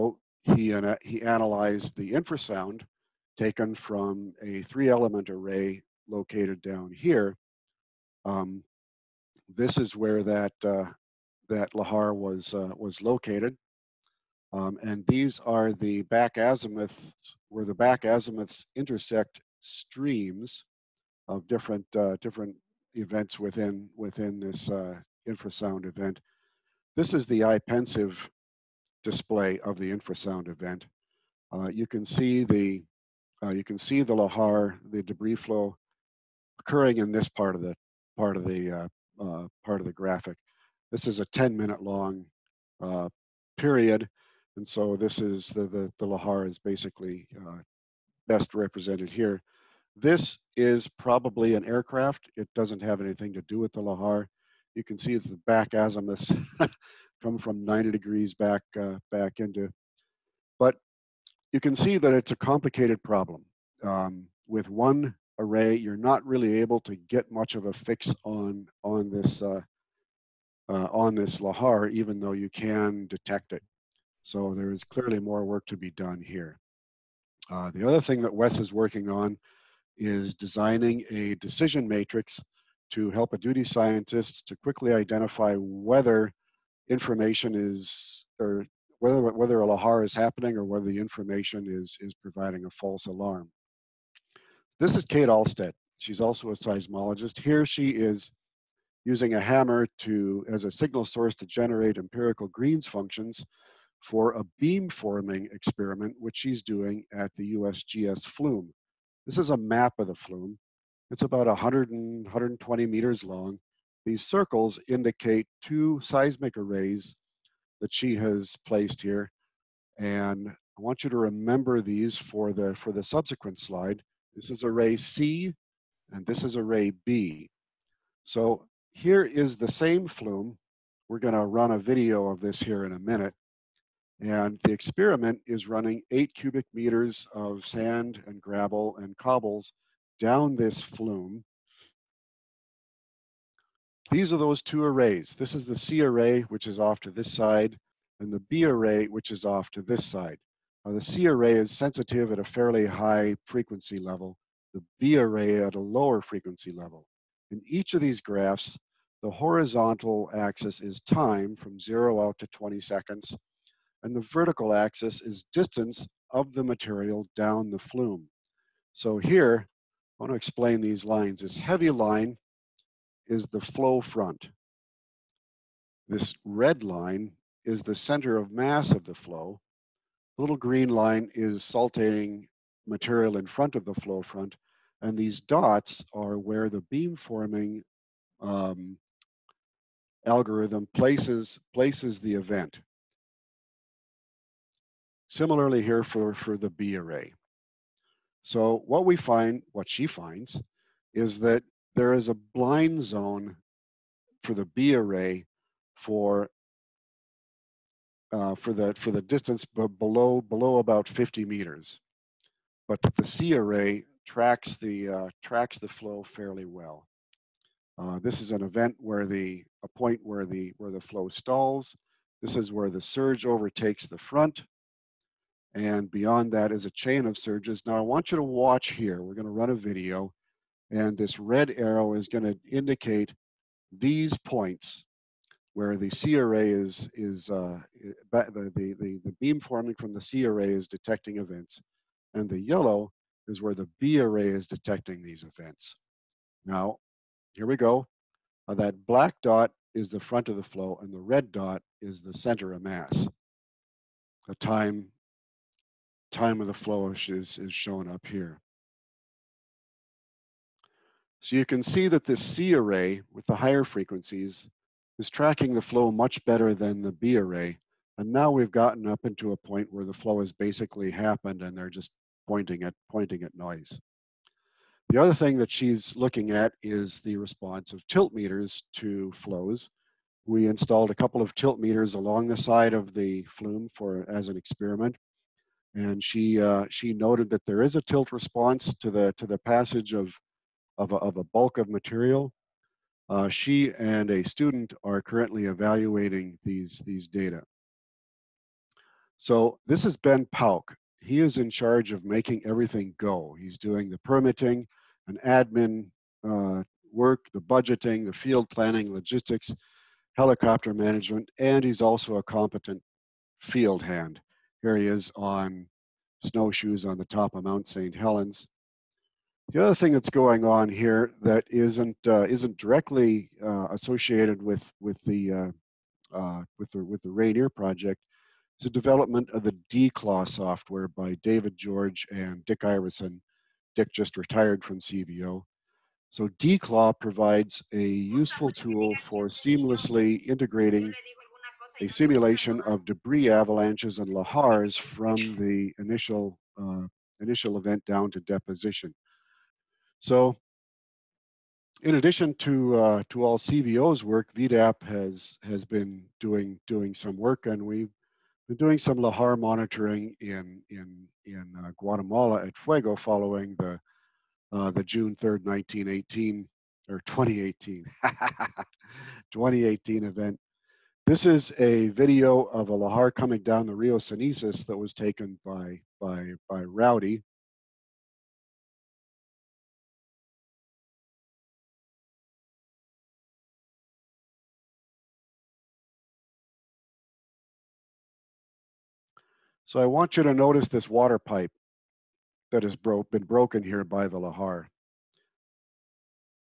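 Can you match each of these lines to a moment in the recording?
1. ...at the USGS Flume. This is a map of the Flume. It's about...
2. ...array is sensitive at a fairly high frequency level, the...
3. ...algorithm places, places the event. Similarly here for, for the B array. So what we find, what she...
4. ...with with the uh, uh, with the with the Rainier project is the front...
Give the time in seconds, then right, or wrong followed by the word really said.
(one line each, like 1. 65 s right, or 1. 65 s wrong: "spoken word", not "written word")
1. 107 s right
2. 151 s right
3. 190 s right
4. 324 s wrong: "development", not "front".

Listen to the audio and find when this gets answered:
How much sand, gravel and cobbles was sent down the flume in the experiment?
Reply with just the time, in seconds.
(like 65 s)
136 s.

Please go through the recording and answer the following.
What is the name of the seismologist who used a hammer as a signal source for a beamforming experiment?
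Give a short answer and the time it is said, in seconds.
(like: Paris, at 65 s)
Kate Allstadt, at 95 s.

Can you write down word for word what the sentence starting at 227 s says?
Now I want you to watch here.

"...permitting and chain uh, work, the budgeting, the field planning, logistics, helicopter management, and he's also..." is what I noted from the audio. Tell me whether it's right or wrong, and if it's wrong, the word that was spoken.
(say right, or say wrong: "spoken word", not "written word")
wrong: "admin", not "chain".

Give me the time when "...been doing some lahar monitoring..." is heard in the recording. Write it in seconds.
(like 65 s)
358 s.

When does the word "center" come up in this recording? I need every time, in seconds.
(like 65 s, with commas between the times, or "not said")
177 s, 252 s.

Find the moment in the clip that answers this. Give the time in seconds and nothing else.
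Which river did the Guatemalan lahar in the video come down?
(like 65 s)
373 s.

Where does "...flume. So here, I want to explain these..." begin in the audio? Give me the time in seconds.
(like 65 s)
167 s.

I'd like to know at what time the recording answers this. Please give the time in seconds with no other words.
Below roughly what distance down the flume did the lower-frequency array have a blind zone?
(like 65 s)
211 s.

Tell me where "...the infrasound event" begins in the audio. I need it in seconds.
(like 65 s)
29 s.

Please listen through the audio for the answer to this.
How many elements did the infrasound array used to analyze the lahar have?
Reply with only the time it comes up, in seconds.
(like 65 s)
4 s.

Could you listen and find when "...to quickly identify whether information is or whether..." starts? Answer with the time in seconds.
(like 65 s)
84 s.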